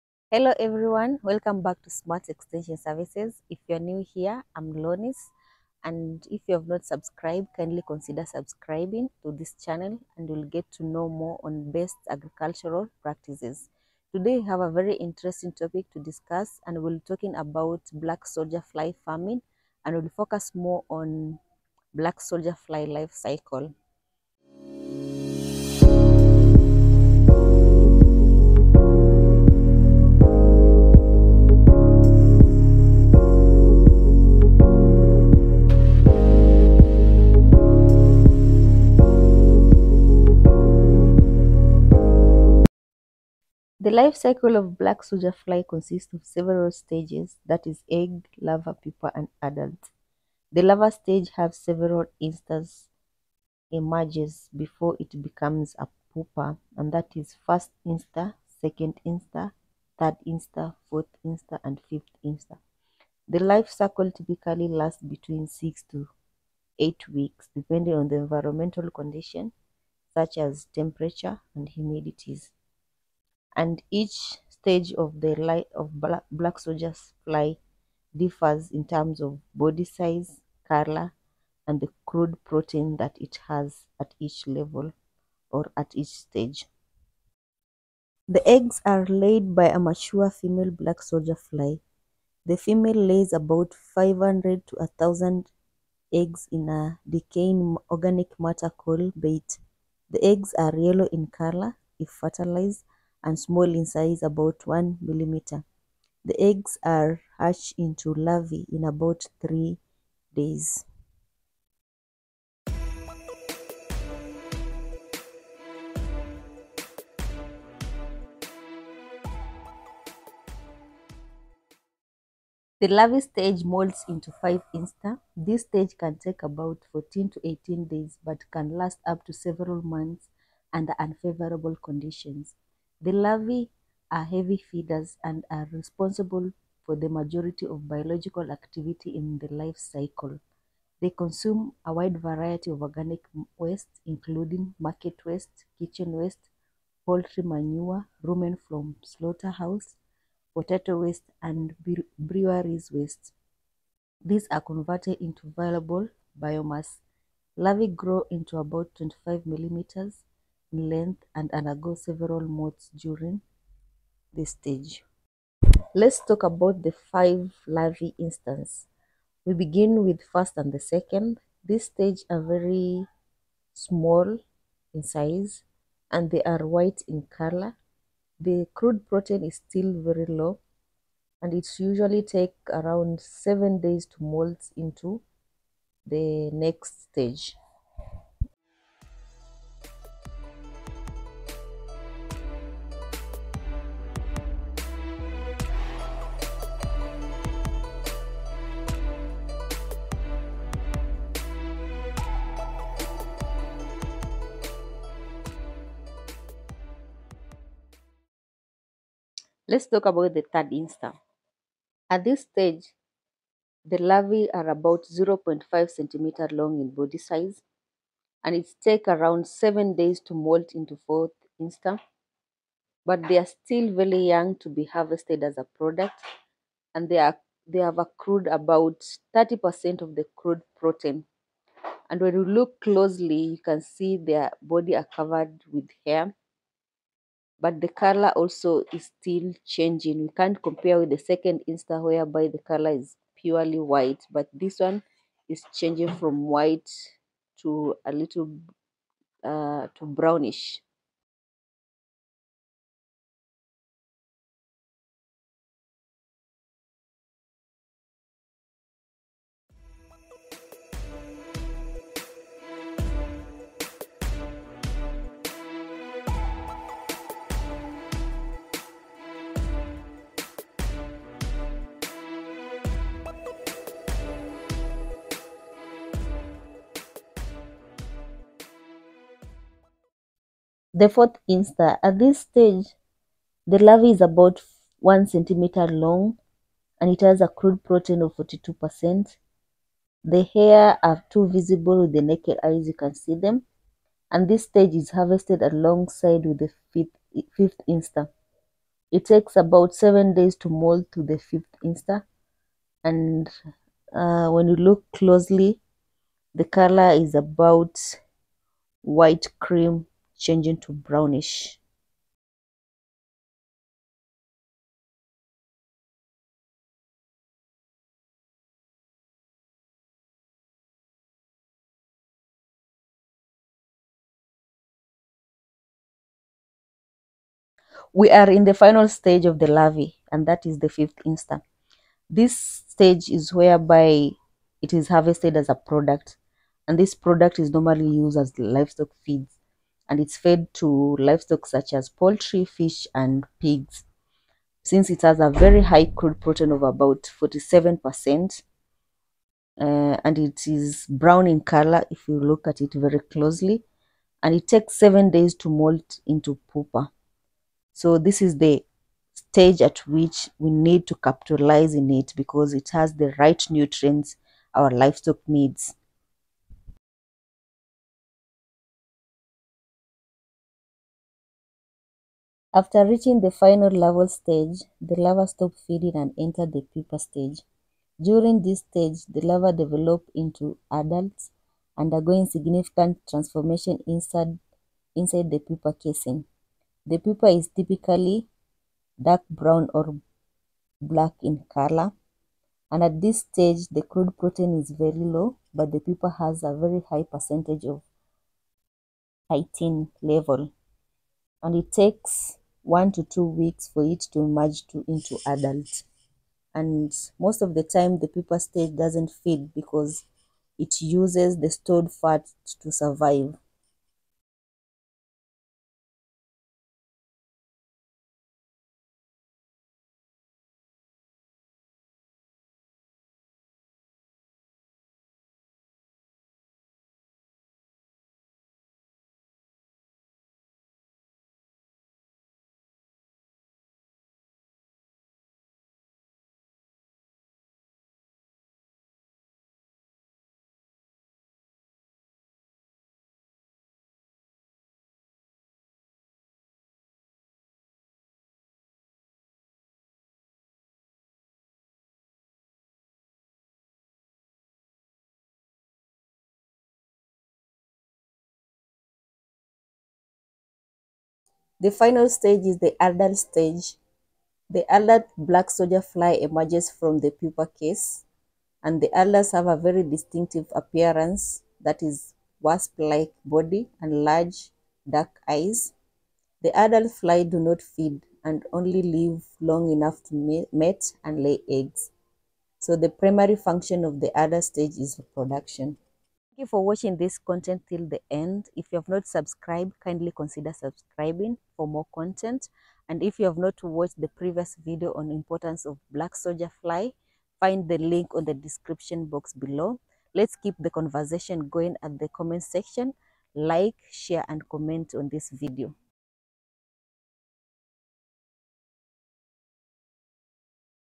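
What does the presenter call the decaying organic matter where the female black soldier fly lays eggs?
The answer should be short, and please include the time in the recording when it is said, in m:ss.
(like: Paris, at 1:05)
bait, at 1:39.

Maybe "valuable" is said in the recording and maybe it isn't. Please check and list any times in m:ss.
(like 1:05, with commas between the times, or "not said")
2:35.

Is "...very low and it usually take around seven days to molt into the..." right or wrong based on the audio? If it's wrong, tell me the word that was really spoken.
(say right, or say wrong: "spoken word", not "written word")
right.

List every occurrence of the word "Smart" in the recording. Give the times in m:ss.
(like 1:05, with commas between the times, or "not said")
0:01.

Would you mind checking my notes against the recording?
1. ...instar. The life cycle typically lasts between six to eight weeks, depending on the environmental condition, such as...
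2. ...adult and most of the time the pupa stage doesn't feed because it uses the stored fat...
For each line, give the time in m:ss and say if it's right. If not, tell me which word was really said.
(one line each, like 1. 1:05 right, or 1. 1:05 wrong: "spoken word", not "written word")
1. 1:02 right
2. 6:45 right.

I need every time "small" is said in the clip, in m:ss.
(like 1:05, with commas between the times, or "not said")
1:43, 2:53.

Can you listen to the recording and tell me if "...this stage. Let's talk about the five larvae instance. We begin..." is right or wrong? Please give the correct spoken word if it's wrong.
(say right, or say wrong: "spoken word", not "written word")
right.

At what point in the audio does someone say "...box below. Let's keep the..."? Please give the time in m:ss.
8:19.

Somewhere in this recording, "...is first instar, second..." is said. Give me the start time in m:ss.
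0:57.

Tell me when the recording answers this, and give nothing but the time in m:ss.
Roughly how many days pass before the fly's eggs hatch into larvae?
1:49.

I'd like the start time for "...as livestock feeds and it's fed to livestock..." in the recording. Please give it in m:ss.
5:38.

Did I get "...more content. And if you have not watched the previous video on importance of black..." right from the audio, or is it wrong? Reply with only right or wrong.
right.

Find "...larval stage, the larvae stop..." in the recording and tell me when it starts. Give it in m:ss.
6:13.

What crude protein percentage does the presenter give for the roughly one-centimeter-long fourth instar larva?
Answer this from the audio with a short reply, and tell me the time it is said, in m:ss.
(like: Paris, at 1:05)
42%, at 4:48.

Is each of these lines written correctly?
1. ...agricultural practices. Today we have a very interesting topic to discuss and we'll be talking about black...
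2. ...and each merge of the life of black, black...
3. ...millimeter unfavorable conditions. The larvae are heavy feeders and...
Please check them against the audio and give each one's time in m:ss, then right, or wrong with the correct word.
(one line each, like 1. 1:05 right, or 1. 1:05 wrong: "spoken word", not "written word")
1. 0:12 right
2. 1:13 wrong: "stage", not "merge"
3. 2:10 wrong: "under", not "millimeter".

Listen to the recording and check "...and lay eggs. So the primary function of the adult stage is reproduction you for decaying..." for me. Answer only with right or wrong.
wrong.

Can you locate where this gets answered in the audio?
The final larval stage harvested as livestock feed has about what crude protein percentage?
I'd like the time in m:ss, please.
5:47.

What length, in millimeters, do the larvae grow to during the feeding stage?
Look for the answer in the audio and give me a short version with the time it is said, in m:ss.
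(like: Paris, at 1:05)
25 millimeters, at 2:38.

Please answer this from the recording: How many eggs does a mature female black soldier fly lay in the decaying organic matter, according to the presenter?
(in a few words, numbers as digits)
500 to 1000.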